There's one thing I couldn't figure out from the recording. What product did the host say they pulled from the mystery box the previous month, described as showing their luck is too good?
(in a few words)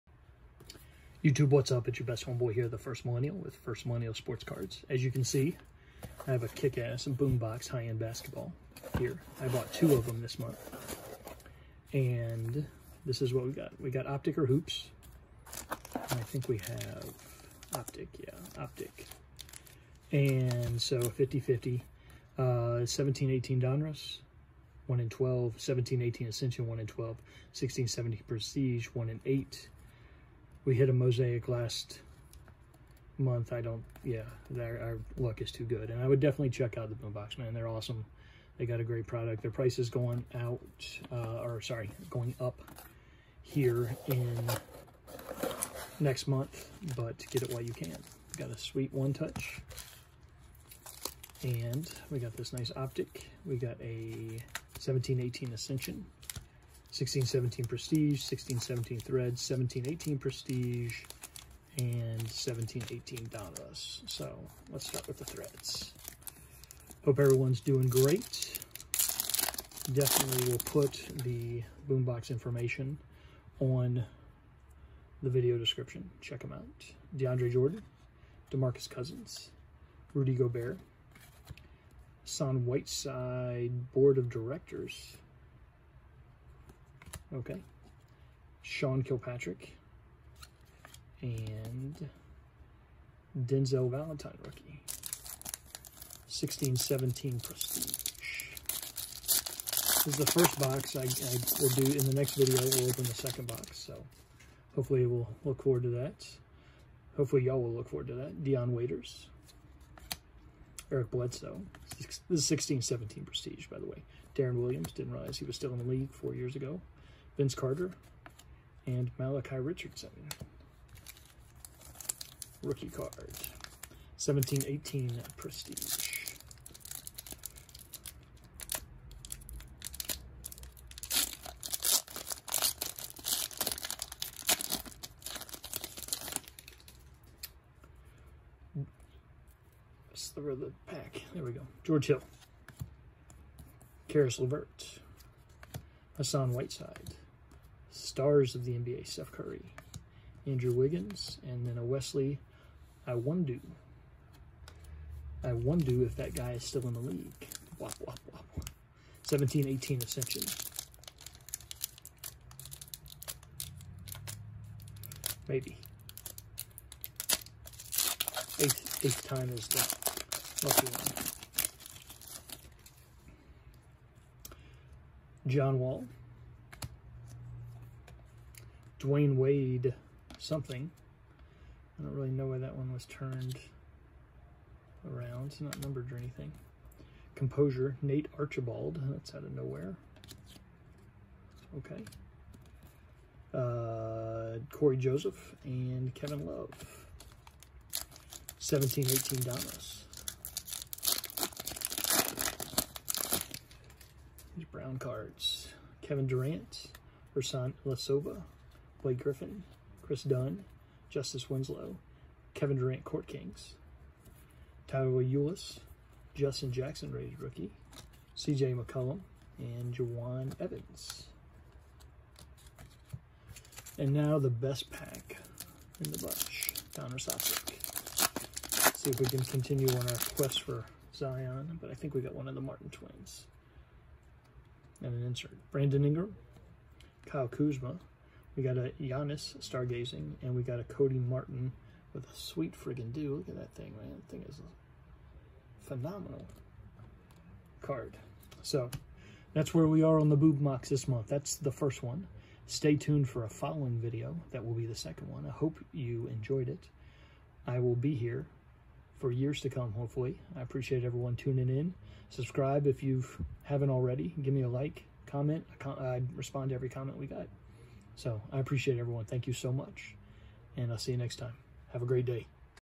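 Mosaic.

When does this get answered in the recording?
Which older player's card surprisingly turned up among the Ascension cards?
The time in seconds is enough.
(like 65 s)
188 s.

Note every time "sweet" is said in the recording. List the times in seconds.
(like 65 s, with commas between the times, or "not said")
48 s, 242 s.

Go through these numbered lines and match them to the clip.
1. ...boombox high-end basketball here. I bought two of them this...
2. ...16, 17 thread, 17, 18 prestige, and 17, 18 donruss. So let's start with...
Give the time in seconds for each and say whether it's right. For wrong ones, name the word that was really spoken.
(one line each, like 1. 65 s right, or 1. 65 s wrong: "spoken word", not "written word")
1. 7 s right
2. 58 s right.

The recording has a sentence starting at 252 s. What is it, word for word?
Stay tuned for a following video.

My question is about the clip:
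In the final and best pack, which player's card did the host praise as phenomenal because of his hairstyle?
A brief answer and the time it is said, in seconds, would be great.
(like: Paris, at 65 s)
Cody Martin, at 240 s.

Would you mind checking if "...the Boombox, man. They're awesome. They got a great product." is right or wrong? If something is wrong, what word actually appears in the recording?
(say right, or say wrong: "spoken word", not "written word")
right.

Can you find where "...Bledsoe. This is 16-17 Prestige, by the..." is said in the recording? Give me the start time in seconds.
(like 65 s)
111 s.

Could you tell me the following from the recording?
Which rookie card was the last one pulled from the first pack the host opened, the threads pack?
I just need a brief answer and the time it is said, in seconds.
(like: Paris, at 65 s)
Denzel Valentine, at 93 s.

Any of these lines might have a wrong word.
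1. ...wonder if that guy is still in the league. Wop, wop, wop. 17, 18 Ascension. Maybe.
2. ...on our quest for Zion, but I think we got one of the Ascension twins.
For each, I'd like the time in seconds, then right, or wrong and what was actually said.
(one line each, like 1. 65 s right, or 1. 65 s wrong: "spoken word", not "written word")
1. 153 s right
2. 229 s wrong: "Martin", not "Ascension".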